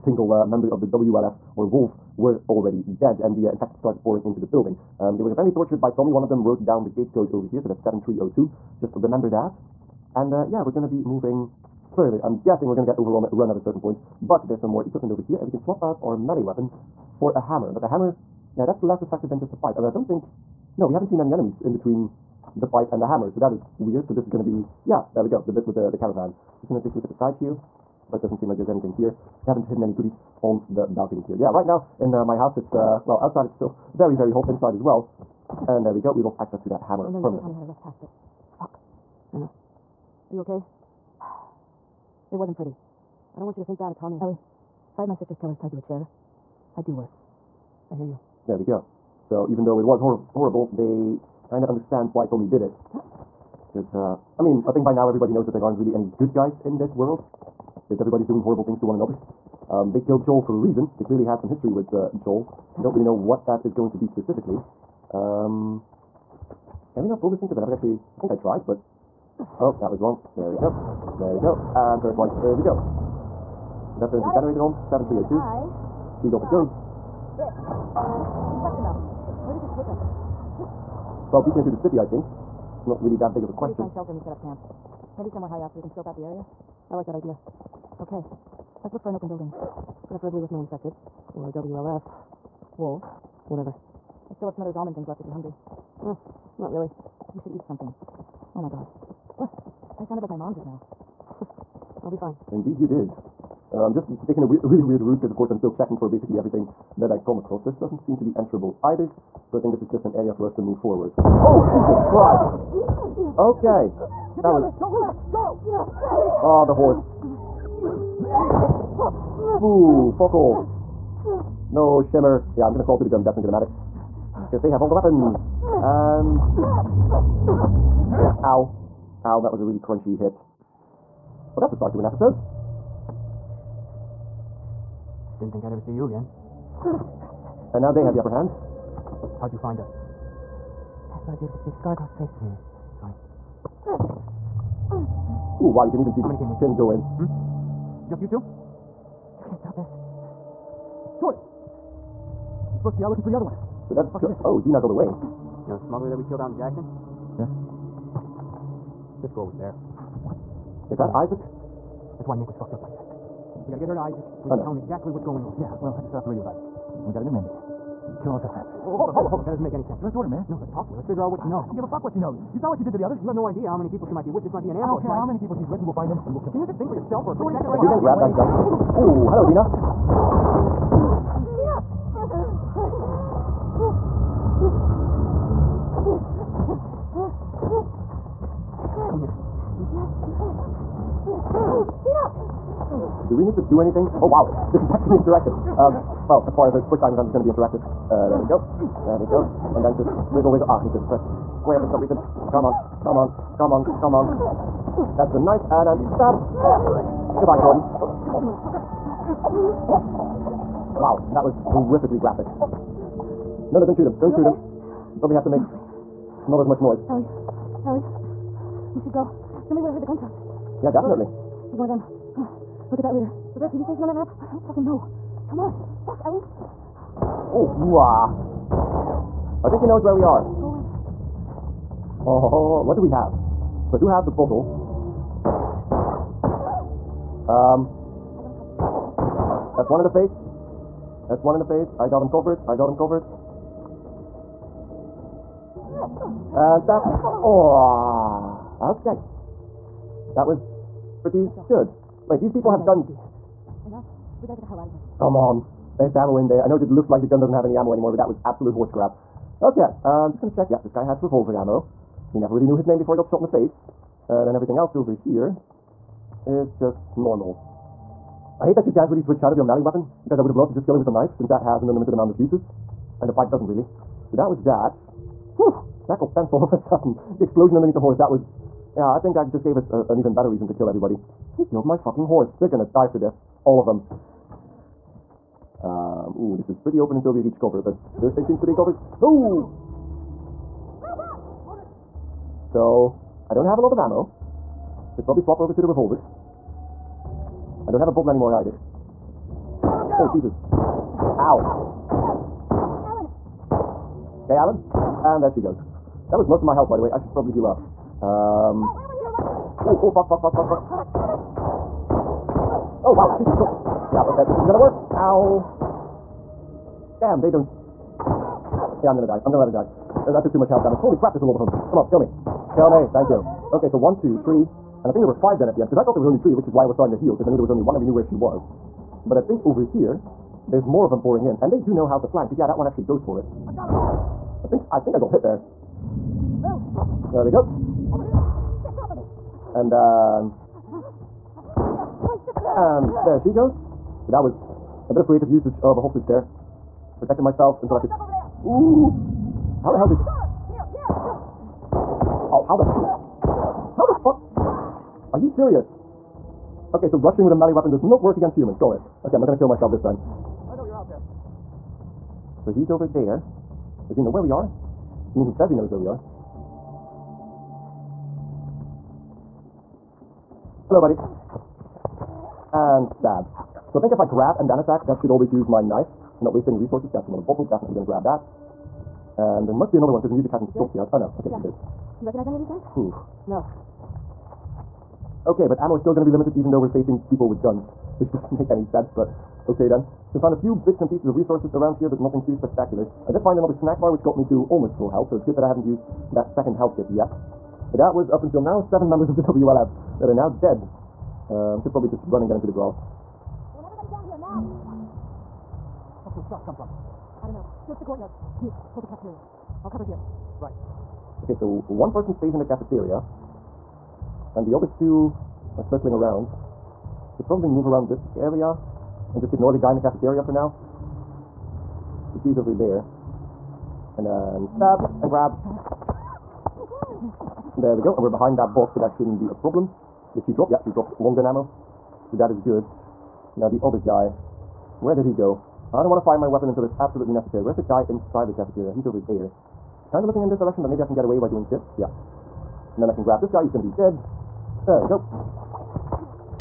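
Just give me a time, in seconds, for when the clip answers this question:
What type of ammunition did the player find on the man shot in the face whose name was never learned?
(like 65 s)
261 s.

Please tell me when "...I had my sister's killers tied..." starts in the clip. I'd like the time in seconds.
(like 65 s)
44 s.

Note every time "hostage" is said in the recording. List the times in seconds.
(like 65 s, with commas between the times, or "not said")
346 s.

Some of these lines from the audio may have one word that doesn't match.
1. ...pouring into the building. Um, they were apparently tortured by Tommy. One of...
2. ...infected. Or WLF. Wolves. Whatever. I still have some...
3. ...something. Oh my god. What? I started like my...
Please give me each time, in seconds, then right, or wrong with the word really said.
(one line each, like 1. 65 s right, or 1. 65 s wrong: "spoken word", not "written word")
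1. 4 s right
2. 90 s right
3. 97 s wrong: "sounded", not "started".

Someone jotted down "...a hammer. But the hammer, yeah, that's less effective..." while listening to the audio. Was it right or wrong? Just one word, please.
right.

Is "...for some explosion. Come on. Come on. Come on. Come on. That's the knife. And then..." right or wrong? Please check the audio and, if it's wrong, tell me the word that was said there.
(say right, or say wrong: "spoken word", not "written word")
wrong: "reason", not "explosion".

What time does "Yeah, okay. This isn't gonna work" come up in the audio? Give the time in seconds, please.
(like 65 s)
314 s.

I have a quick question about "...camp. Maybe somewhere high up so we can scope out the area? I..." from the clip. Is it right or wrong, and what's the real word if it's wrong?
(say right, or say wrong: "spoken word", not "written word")
right.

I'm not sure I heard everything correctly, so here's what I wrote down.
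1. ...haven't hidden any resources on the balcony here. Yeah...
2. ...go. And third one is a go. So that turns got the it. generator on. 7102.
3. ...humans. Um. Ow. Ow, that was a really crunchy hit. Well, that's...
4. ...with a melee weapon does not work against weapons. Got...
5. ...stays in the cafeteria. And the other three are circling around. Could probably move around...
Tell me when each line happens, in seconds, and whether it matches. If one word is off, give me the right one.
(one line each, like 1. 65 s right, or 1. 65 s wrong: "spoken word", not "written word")
1. 29 s wrong: "goodies", not "resources"
2. 71 s wrong: "7302", not "7102"
3. 124 s wrong: "weapons", not "humans"
4. 357 s wrong: "humans", not "weapons"
5. 412 s wrong: "two", not "three".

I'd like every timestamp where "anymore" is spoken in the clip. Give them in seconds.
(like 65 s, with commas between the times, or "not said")
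257 s, 298 s.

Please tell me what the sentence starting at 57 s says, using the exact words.
Because everybody's doing horrible things to one another.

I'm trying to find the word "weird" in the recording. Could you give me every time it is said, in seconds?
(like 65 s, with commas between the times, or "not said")
23 s, 104 s.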